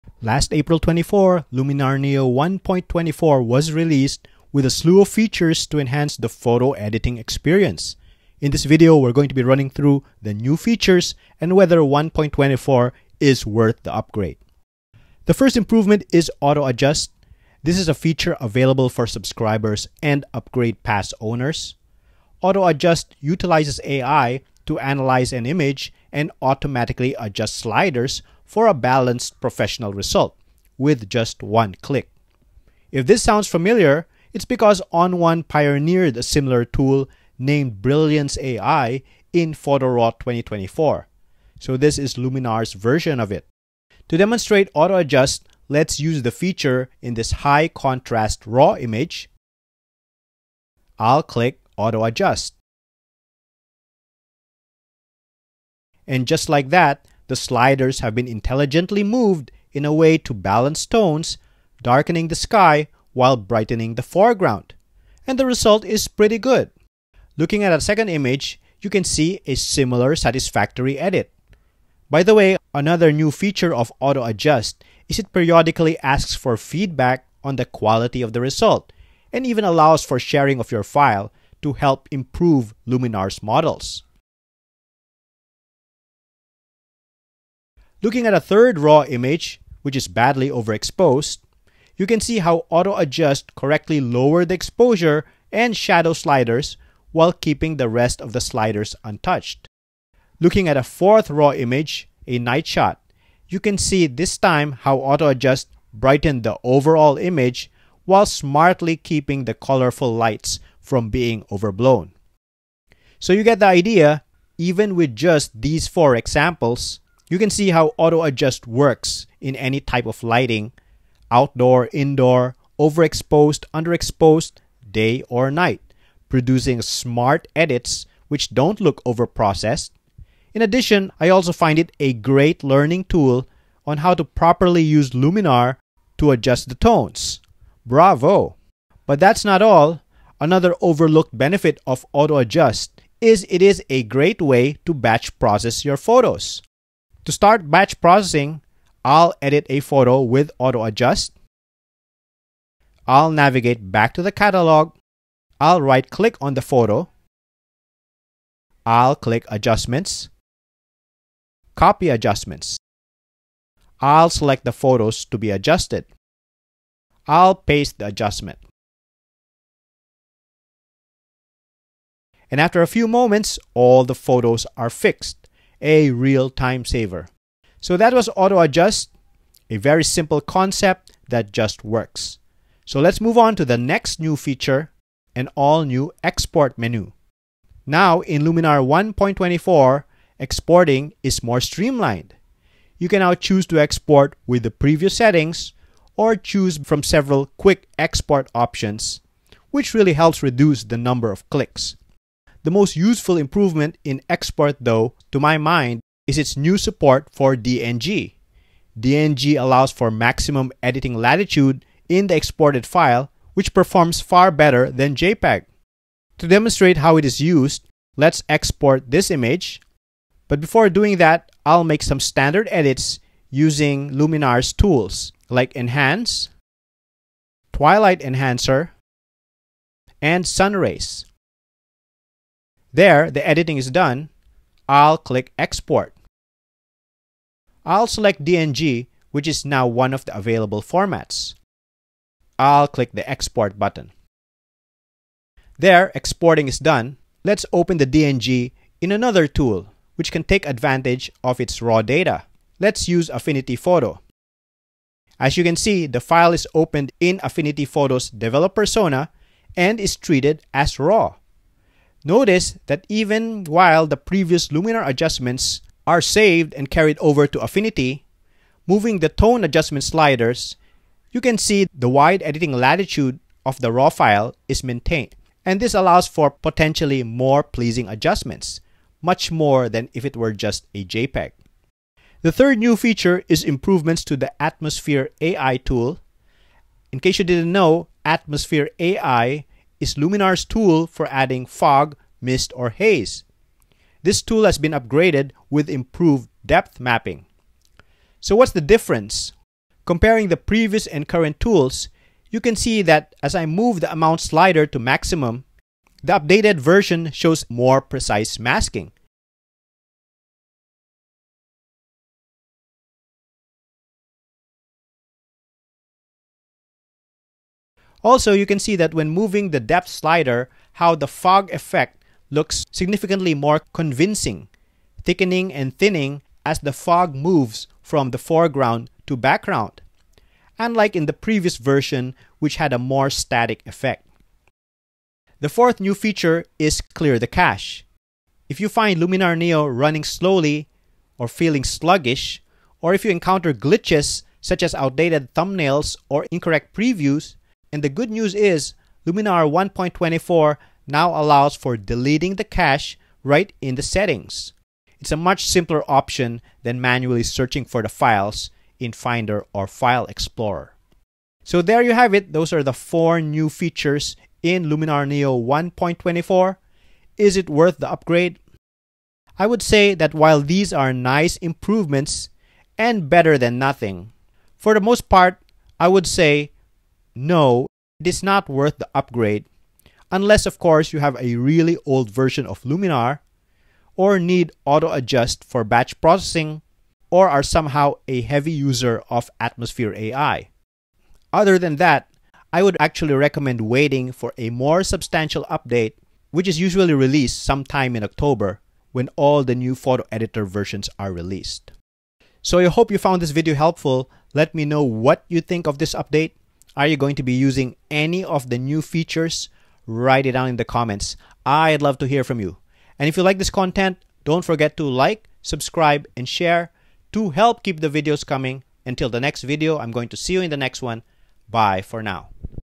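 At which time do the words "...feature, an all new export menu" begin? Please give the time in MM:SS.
03:04.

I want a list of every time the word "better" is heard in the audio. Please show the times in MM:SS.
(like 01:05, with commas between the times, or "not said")
03:34, 06:13.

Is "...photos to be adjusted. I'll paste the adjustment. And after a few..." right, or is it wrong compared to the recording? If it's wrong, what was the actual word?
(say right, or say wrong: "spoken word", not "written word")
right.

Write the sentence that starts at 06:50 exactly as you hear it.
Write it down in the comments.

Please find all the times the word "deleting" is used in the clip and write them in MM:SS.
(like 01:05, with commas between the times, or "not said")
05:51.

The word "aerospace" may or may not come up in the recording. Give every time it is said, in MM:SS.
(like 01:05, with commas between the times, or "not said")
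not said.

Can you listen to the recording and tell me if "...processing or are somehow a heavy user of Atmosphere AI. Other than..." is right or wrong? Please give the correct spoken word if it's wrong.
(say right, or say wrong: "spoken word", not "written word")
right.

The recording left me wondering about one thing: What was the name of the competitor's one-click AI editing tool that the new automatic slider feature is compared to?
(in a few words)
Brilliance AI.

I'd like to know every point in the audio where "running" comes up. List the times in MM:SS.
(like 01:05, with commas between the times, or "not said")
00:09, 05:39.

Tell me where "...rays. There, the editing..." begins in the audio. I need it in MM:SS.
03:50.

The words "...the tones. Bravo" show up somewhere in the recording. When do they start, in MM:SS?
02:16.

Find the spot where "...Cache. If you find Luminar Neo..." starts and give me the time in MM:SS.
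05:37.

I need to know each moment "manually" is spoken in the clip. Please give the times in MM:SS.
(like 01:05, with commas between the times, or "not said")
05:57.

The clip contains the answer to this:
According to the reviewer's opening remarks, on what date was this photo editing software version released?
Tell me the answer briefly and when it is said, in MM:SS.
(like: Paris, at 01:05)
April 24, at 00:00.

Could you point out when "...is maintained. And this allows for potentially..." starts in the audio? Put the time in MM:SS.
04:34.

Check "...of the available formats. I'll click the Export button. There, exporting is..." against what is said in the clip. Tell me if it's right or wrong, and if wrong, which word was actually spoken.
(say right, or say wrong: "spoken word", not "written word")
right.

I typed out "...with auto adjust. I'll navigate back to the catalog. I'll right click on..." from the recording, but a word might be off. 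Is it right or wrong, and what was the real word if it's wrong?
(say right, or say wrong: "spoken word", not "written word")
right.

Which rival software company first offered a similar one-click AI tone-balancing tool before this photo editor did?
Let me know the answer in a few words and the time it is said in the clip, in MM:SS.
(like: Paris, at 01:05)
On1, at 00:34.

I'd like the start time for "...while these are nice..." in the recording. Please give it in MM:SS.
06:10.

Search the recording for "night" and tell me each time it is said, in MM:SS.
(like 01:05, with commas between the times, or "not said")
01:42, 02:05.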